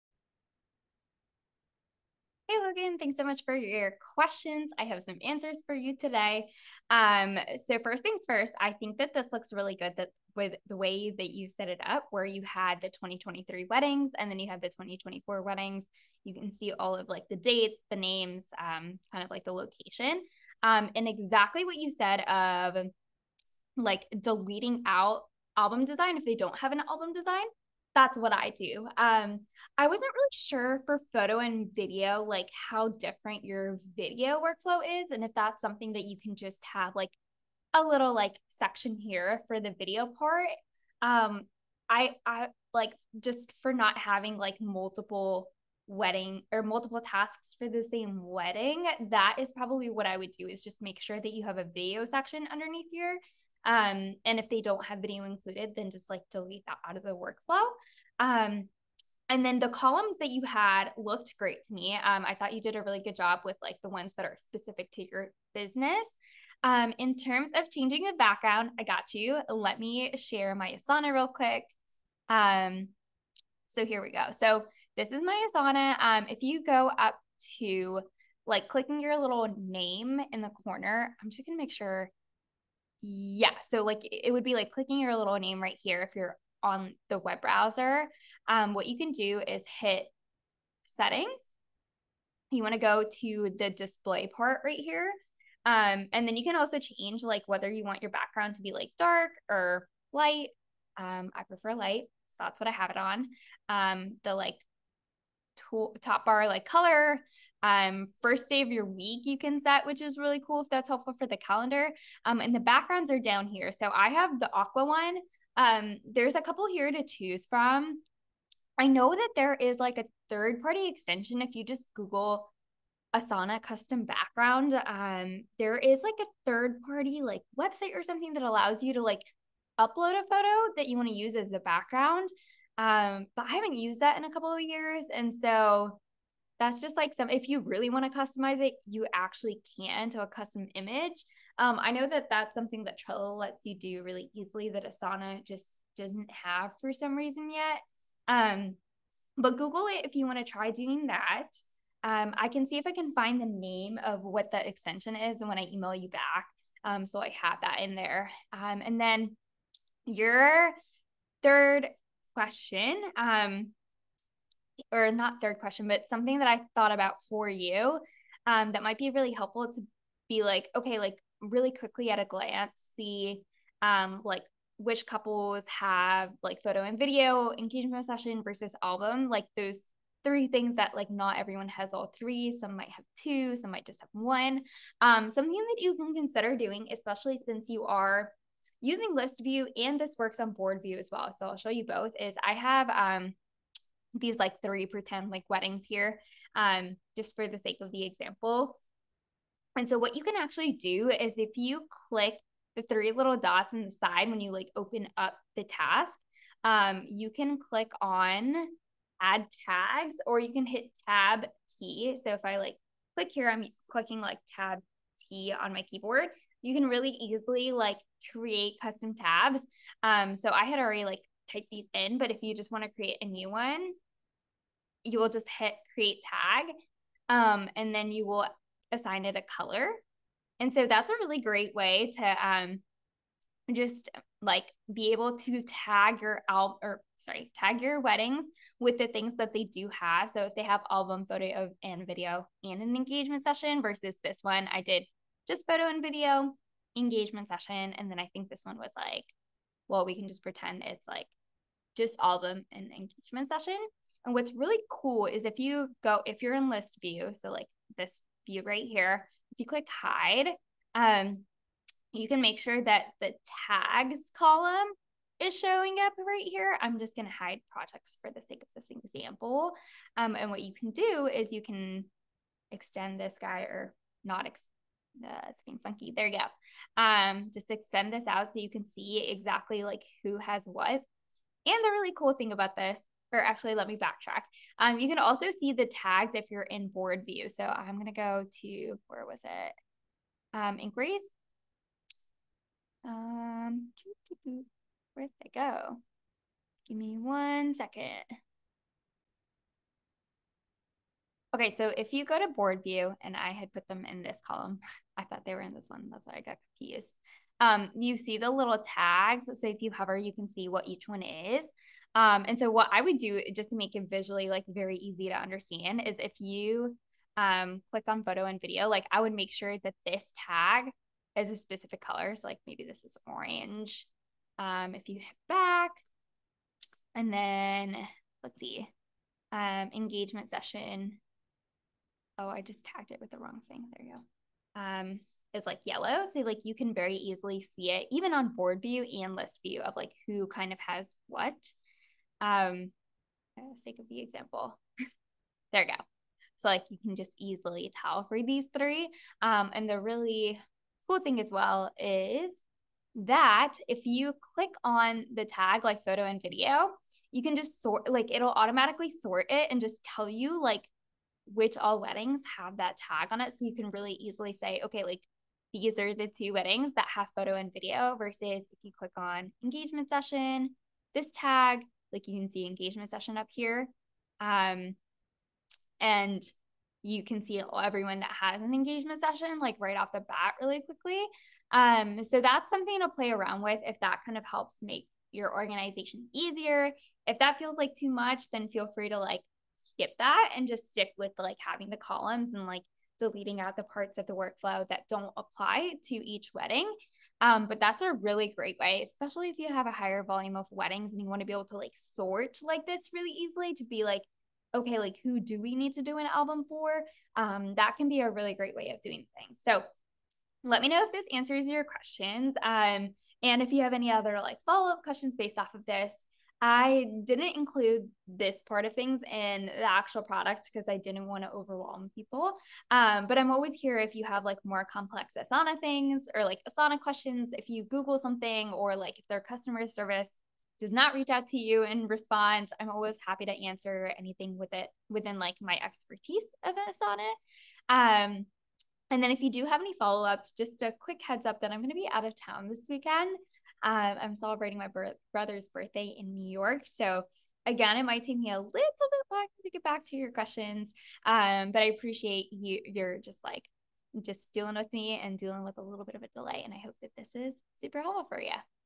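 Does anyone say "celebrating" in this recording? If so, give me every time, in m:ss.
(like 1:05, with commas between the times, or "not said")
7:24.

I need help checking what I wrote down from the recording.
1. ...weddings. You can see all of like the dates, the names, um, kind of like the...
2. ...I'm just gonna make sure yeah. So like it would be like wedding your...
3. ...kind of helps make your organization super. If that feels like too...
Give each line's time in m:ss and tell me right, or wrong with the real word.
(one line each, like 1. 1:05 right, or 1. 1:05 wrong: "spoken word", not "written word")
1. 0:15 right
2. 1:21 wrong: "clicking", not "wedding"
3. 6:24 wrong: "easier", not "super".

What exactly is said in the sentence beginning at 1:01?
Um, I thought you did a really good job with like the ones that are specific to your business.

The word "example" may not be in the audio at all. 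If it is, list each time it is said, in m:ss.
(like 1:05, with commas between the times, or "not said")
3:18, 4:29, 5:44.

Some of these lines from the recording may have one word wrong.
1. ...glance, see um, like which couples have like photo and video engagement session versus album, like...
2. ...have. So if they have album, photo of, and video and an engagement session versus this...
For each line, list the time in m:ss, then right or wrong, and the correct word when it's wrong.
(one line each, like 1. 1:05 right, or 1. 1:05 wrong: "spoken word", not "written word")
1. 2:52 right
2. 3:59 right.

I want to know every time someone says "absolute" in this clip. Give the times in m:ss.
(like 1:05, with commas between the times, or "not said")
not said.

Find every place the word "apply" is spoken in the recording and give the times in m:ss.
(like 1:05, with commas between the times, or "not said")
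6:35.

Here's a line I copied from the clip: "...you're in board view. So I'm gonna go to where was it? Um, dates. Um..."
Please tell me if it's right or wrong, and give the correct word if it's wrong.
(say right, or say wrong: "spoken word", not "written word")
wrong: "inquiries", not "dates".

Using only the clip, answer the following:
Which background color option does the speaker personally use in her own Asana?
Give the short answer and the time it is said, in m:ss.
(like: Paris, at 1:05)
Aqua, at 1:54.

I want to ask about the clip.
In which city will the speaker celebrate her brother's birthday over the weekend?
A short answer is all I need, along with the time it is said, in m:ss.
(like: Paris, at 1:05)
New York, at 7:26.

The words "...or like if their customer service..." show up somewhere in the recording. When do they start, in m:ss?
7:08.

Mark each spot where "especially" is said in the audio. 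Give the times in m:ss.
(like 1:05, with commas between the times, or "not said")
3:06, 6:39.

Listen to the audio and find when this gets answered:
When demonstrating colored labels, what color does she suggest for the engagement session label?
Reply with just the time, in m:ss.
5:35.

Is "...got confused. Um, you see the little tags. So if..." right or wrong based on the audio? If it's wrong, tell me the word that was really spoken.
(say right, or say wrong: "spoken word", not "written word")
right.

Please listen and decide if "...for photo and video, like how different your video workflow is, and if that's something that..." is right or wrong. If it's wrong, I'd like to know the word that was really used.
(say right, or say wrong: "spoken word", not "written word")
right.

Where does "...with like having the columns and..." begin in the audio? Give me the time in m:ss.
6:31.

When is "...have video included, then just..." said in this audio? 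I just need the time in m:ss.
0:54.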